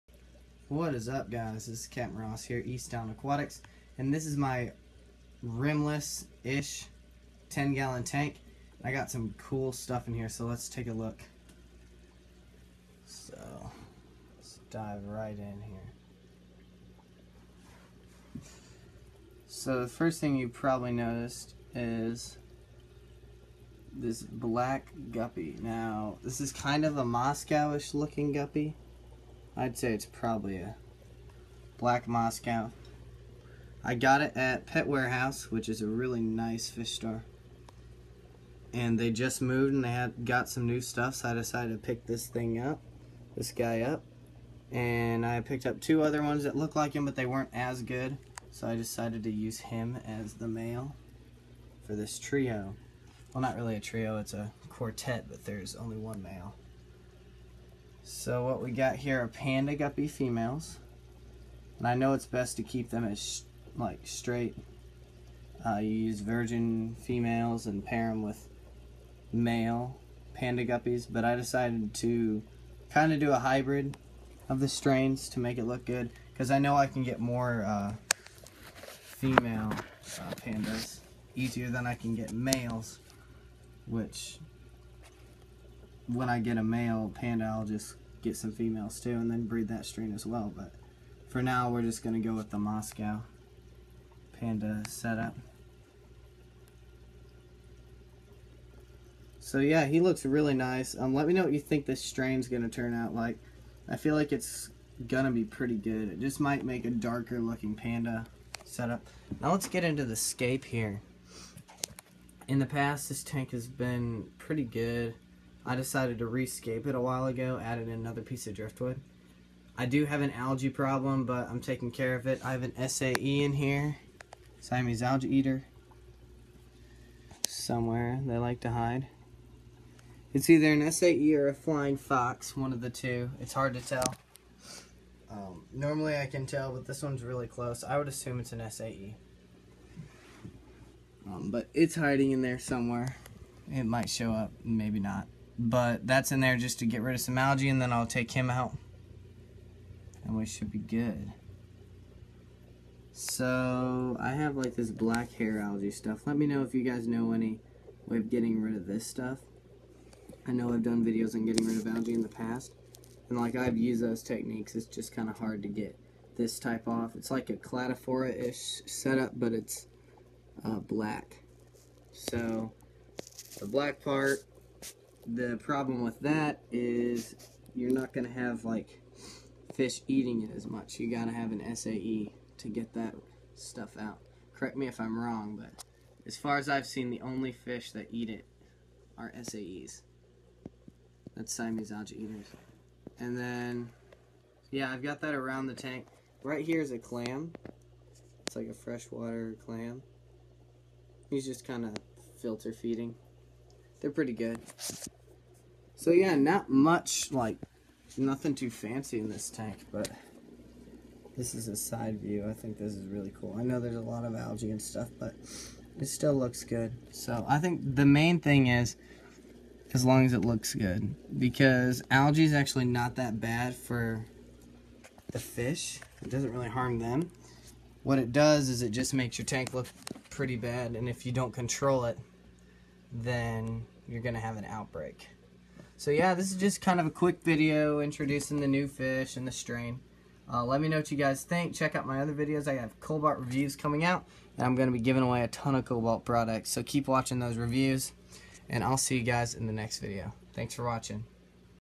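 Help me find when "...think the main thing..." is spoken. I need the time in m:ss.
3:37.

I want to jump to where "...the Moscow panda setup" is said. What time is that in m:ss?
1:32.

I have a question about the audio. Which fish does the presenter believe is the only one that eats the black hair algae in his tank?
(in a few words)
Siamese algae eater.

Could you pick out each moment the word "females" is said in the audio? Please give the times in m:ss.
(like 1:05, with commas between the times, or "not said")
1:00, 1:06, 1:18, 1:28.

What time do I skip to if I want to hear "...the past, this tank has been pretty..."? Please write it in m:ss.
1:52.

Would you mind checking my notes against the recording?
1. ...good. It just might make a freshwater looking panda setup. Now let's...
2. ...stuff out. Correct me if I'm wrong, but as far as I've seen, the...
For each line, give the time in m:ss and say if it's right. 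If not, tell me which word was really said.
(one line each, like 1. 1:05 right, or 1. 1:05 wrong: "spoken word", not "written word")
1. 1:45 wrong: "darker", not "freshwater"
2. 3:03 right.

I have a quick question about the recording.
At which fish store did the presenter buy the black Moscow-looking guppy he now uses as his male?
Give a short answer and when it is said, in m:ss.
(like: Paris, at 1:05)
Pet Warehouse, at 0:34.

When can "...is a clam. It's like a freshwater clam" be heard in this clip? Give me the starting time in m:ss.
3:16.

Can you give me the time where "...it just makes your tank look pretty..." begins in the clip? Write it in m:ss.
3:48.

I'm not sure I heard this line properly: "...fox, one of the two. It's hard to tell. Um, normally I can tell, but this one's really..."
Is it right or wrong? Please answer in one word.
right.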